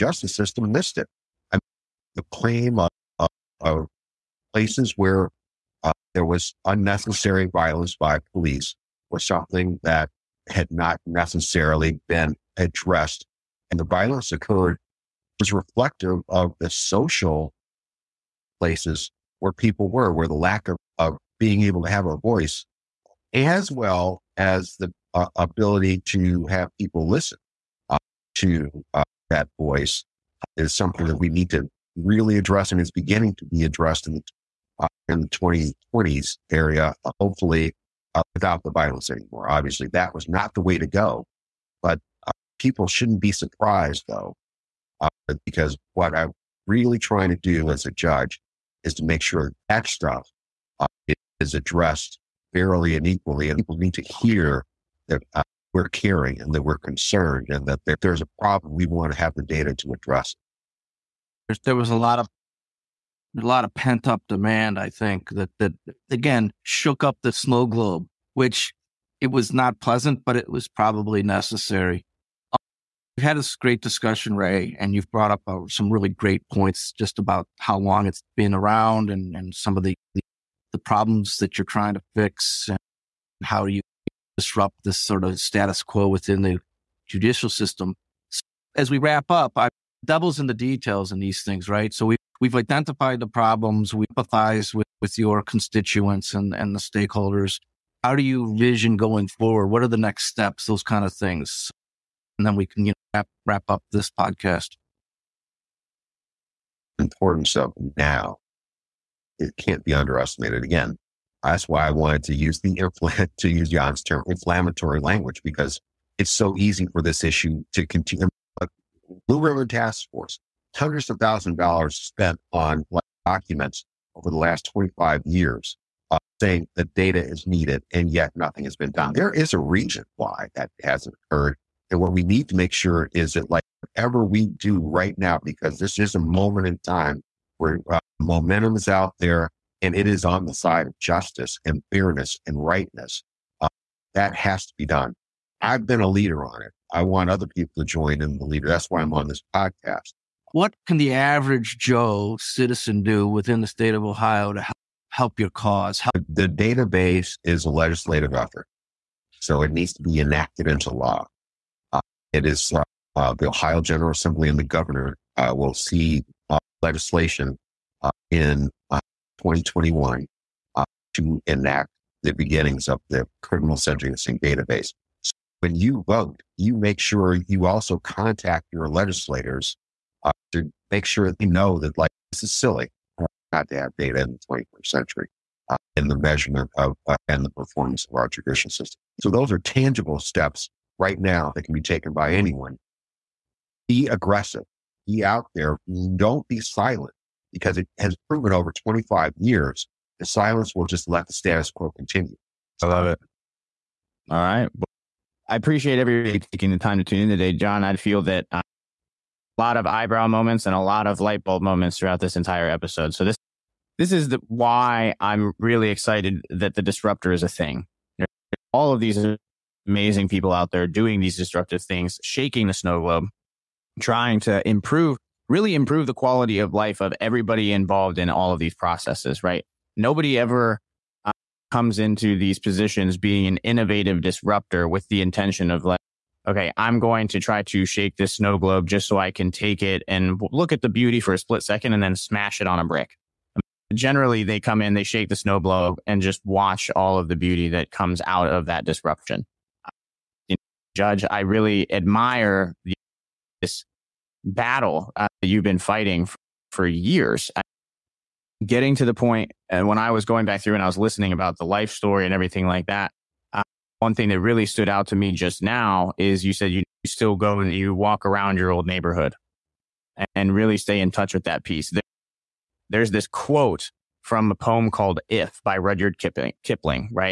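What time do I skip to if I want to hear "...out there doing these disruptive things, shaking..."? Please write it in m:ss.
3:40.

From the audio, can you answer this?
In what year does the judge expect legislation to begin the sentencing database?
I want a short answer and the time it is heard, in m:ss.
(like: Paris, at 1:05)
2021, at 2:49.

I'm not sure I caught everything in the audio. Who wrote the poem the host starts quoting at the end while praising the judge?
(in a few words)
Rudyard Kipling.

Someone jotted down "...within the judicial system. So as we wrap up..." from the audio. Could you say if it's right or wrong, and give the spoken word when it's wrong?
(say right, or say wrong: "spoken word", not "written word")
right.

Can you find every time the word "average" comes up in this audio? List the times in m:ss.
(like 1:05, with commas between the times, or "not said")
2:31.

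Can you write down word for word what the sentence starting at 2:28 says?
That's why I'm on this podcast.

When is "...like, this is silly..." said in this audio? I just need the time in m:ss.
3:01.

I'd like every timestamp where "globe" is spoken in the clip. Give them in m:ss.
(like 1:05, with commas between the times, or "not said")
1:07, 3:42, 3:58, 4:05.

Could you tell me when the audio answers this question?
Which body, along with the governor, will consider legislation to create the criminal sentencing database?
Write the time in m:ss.
2:43.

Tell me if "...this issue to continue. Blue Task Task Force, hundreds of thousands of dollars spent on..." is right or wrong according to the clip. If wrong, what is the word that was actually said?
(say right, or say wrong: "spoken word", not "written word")
wrong: "Ribbon", not "Task".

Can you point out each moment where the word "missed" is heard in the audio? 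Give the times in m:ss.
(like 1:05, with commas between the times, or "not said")
0:00.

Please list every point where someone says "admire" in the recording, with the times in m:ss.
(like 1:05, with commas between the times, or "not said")
4:11.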